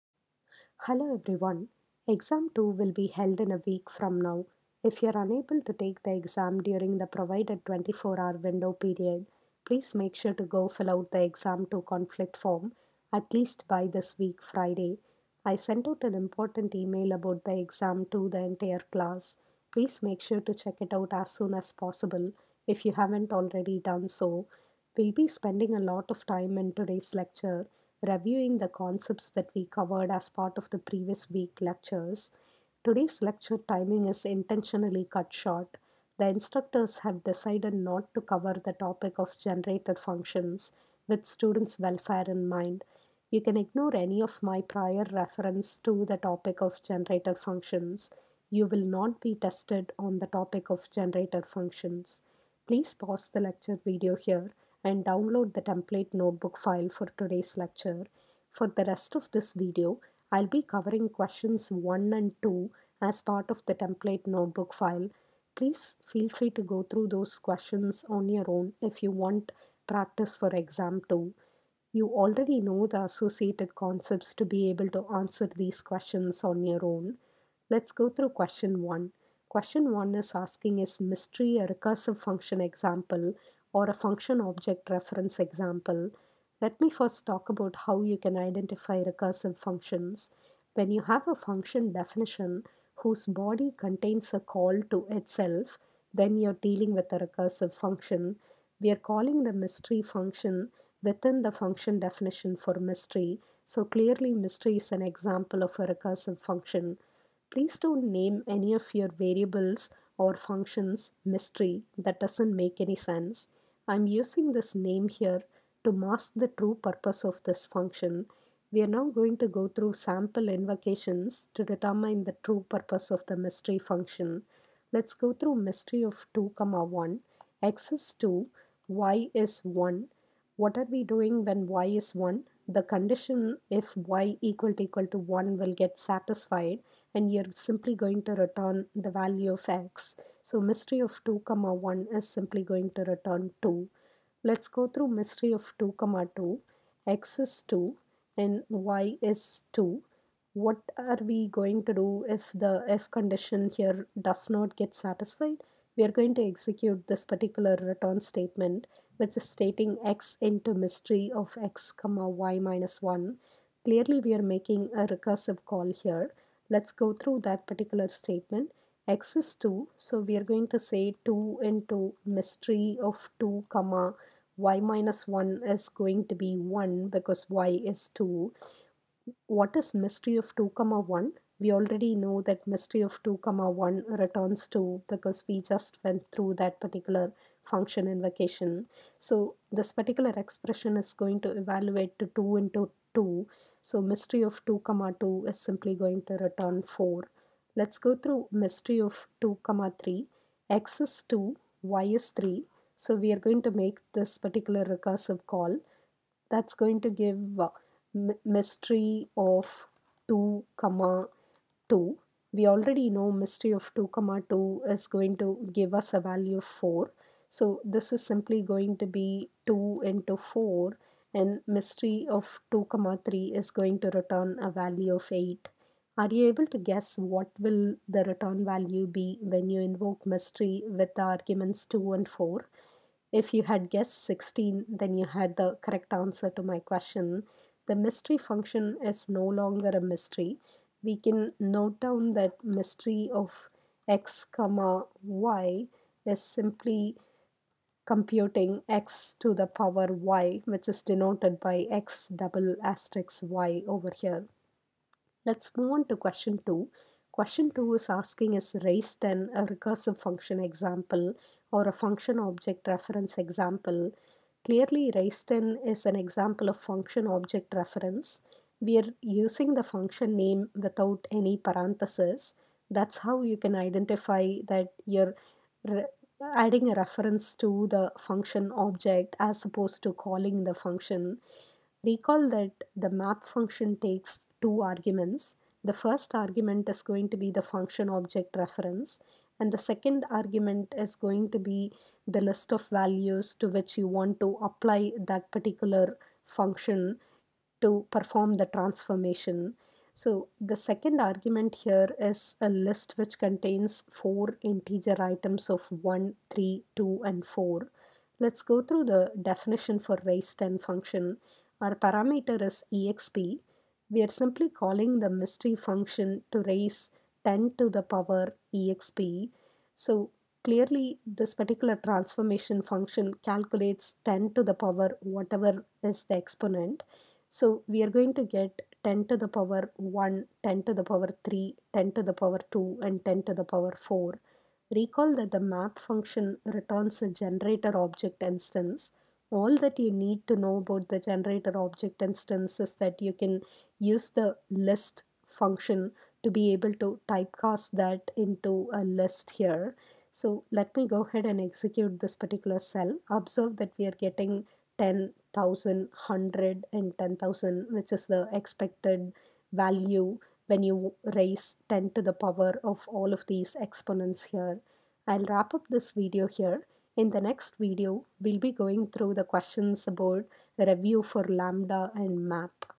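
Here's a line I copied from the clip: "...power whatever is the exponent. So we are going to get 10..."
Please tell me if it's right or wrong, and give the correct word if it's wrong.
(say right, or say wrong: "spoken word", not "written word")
right.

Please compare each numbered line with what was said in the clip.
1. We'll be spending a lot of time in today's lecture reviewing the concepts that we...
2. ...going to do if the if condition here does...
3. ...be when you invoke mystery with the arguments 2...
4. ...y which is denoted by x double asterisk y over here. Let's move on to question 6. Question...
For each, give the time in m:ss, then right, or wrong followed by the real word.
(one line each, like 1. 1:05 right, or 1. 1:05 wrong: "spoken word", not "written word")
1. 0:24 right
2. 2:31 right
3. 3:49 right
4. 4:10 wrong: "2", not "6".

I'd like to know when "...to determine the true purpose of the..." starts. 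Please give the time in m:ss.
2:01.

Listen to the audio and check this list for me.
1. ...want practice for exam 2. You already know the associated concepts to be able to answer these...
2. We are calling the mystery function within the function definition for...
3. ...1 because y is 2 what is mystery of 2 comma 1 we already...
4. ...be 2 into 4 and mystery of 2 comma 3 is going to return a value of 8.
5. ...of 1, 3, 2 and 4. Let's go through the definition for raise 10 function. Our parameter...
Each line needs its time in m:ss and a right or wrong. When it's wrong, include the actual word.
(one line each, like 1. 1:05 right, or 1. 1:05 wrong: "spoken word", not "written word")
1. 1:09 right
2. 1:38 right
3. 2:56 right
4. 3:39 right
5. 5:05 right.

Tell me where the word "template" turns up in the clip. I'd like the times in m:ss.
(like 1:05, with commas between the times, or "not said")
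0:55, 1:03.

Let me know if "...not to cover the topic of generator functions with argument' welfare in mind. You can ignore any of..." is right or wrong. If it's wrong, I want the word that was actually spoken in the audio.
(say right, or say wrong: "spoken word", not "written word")
wrong: "students", not "argument".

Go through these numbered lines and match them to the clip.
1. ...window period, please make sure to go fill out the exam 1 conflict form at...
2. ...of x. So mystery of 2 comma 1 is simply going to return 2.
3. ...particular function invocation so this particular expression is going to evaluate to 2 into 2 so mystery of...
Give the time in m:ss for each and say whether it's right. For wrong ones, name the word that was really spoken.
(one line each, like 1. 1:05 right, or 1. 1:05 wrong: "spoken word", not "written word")
1. 0:08 wrong: "2", not "1"
2. 2:19 right
3. 3:06 right.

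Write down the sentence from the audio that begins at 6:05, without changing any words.
I'll wrap up this video here.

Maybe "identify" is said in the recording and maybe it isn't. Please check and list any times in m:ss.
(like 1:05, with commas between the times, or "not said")
1:28, 4:33.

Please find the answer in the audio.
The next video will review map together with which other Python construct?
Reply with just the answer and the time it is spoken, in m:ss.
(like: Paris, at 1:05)
lambda, at 6:11.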